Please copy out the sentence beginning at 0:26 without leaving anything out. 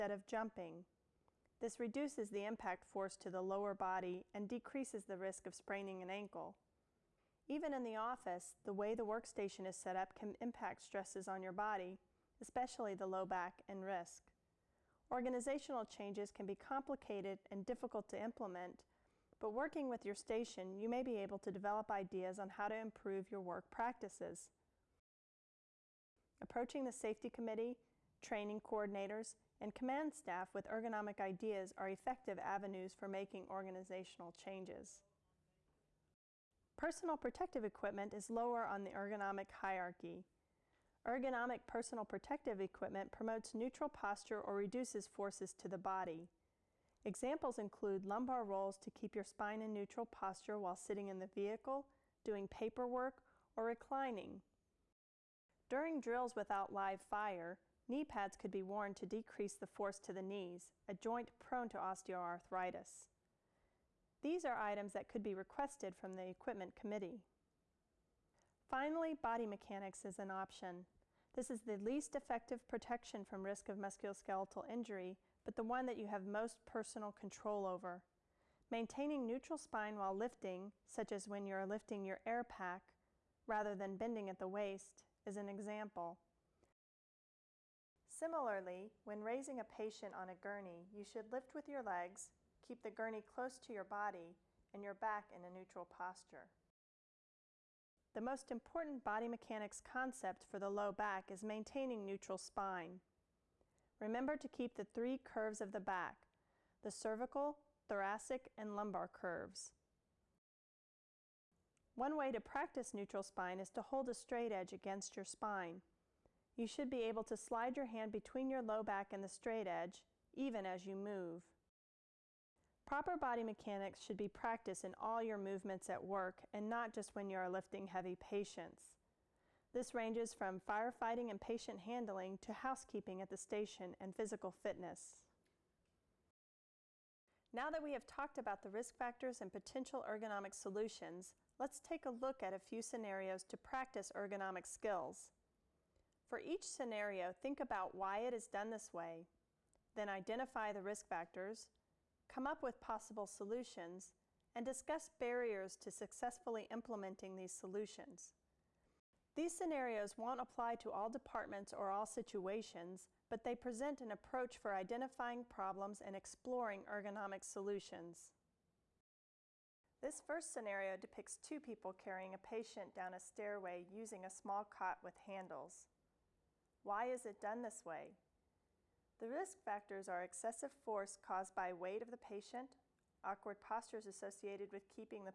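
Approaching the safety committee, training coordinators, and command staff with ergonomic ideas are effective avenues for making organizational changes.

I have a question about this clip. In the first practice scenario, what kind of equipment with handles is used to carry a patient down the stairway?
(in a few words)
a small cot.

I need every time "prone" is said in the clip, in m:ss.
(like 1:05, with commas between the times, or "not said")
1:01.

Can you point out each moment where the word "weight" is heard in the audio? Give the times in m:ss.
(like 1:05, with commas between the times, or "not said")
3:01.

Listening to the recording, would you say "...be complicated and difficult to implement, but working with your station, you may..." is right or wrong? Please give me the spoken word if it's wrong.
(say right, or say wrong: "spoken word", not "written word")
right.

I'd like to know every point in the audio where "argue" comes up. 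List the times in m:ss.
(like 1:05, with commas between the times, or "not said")
not said.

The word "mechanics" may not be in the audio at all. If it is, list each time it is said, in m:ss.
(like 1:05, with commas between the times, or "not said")
1:09, 1:39, 2:03.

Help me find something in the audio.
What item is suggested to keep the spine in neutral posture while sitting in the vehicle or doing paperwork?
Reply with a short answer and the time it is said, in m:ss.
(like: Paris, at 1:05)
lumbar rolls, at 0:48.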